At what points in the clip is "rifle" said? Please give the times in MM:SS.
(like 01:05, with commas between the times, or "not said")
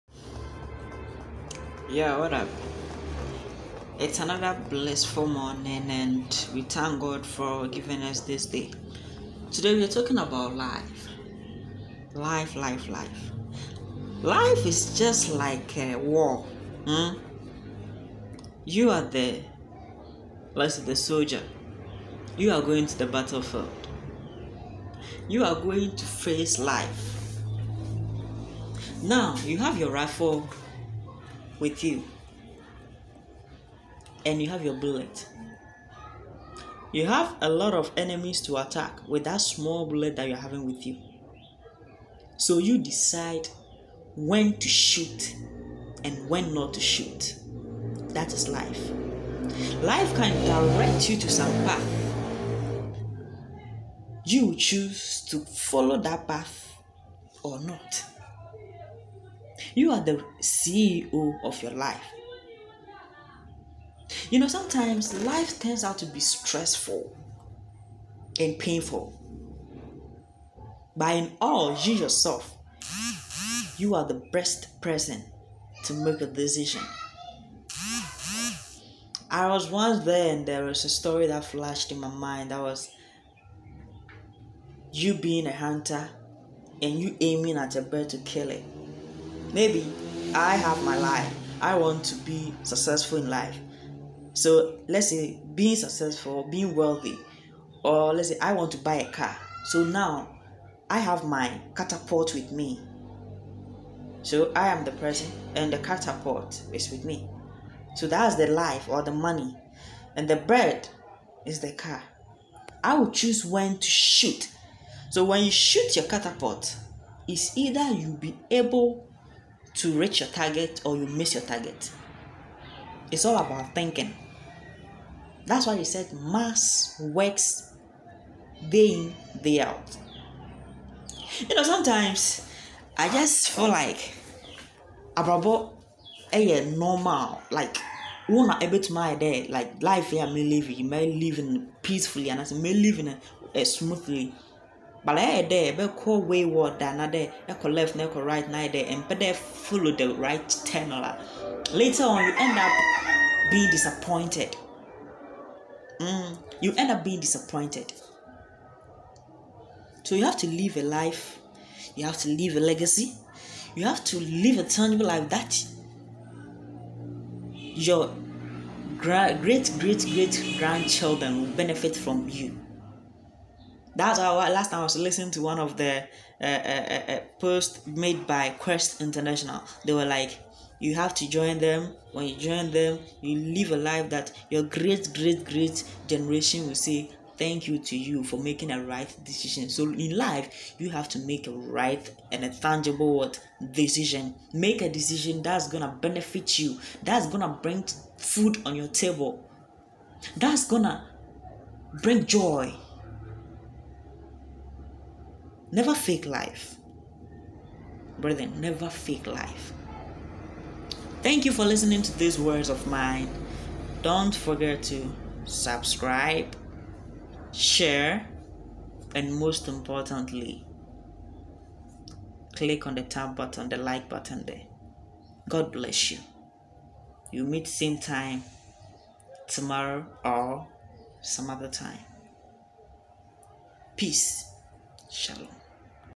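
00:29.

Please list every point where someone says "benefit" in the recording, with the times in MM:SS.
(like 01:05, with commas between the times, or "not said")
02:51, 03:16.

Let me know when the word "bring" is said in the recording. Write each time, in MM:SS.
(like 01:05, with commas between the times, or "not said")
03:17, 03:22.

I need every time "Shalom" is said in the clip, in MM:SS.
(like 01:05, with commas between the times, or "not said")
03:55.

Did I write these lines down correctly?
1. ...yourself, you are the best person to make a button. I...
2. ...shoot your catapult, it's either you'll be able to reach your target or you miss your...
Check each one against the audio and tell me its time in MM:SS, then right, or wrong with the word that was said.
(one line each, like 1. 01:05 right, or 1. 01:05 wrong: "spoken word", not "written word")
1. 01:11 wrong: "decision", not "button"
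2. 01:55 right.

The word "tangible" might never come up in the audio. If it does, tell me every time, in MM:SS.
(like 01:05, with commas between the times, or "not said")
02:44, 03:12.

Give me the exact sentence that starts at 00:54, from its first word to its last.
You choose to follow that path or not.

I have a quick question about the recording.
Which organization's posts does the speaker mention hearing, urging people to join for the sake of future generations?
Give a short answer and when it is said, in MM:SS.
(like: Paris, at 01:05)
Quest International, at 02:58.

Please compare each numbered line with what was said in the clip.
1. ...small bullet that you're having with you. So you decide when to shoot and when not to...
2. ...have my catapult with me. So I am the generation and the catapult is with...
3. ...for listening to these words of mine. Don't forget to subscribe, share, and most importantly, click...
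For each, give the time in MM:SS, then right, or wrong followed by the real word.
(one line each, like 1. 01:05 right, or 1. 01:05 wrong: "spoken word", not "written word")
1. 00:39 right
2. 01:40 wrong: "person", not "generation"
3. 03:31 right.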